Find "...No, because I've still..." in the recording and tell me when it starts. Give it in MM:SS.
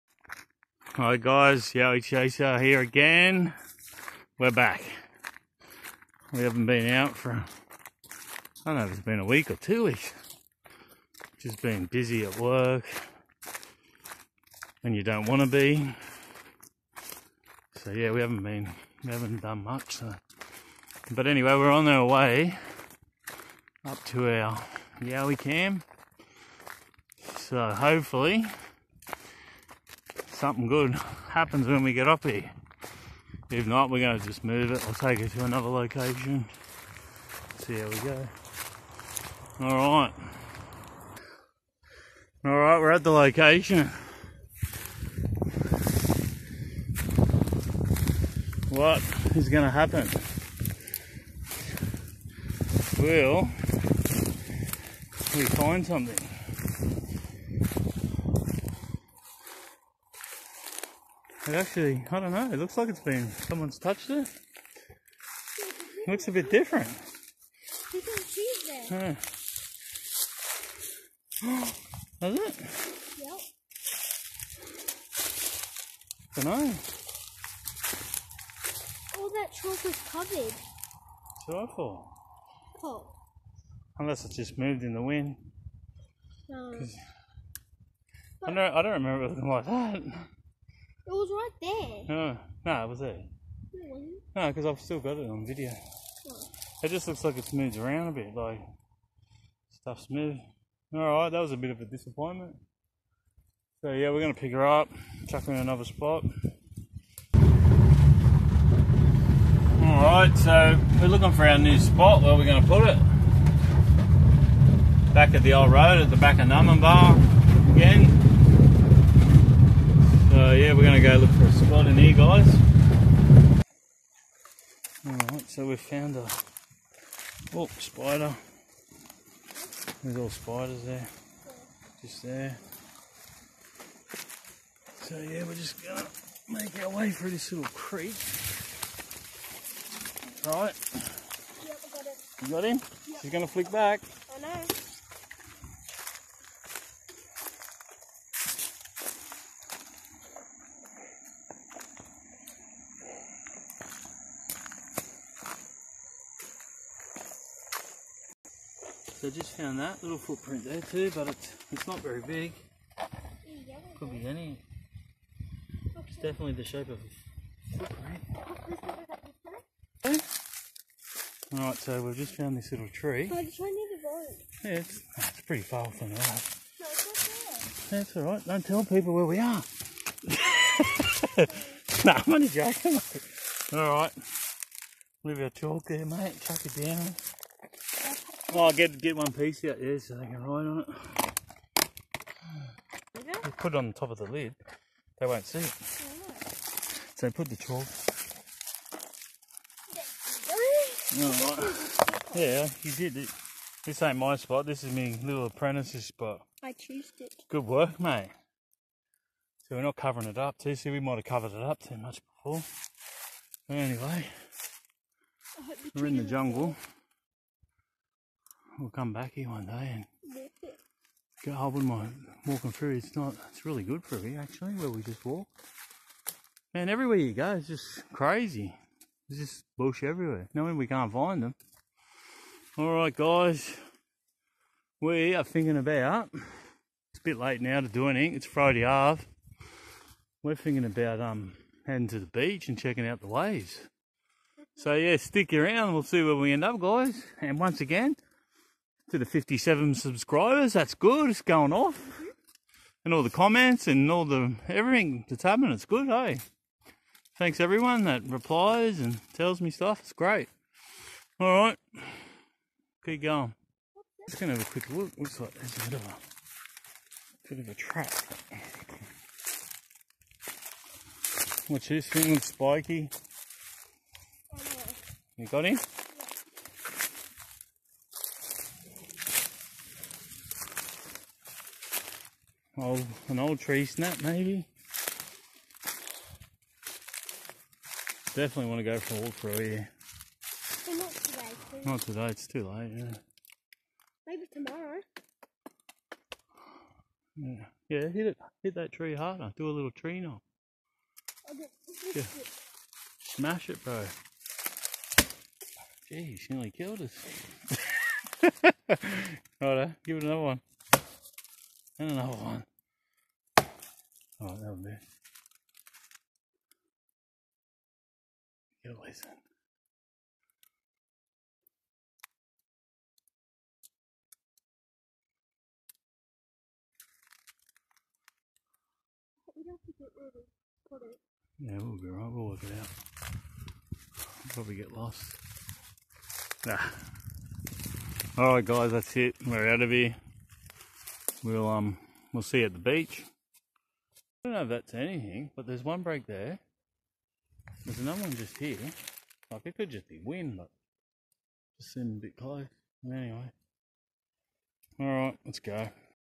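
01:34.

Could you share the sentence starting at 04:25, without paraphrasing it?
Looks like there's a bit of a bit of a trap.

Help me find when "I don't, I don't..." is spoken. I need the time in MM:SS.
01:28.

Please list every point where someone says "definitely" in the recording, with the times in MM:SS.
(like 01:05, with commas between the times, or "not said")
02:46, 04:48.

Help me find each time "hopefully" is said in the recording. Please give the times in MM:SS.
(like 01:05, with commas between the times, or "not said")
00:27.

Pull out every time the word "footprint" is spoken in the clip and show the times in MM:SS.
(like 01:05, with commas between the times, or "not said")
02:40, 02:47.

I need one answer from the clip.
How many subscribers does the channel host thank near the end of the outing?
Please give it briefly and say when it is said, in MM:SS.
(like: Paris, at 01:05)
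57, at 04:09.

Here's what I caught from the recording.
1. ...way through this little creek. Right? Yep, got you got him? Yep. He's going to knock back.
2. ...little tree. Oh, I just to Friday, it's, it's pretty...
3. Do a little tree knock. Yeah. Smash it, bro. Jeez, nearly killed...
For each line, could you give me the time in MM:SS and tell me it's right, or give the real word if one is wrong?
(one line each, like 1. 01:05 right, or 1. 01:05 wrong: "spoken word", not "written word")
1. 02:16 wrong: "flick", not "knock"
2. 02:52 wrong: "Yeah", not "Friday"
3. 04:59 right.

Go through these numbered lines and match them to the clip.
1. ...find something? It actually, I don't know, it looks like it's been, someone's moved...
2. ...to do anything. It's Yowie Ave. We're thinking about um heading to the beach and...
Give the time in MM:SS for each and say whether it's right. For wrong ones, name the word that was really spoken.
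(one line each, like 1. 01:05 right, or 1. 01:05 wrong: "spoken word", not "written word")
1. 00:55 wrong: "touched", not "moved"
2. 03:57 wrong: "Friday", not "Yowie".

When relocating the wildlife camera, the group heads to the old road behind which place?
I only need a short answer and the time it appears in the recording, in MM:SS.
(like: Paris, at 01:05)
Numinbah, at 01:56.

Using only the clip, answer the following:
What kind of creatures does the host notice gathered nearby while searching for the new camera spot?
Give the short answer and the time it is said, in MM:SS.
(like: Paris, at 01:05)
Spiders, at 02:10.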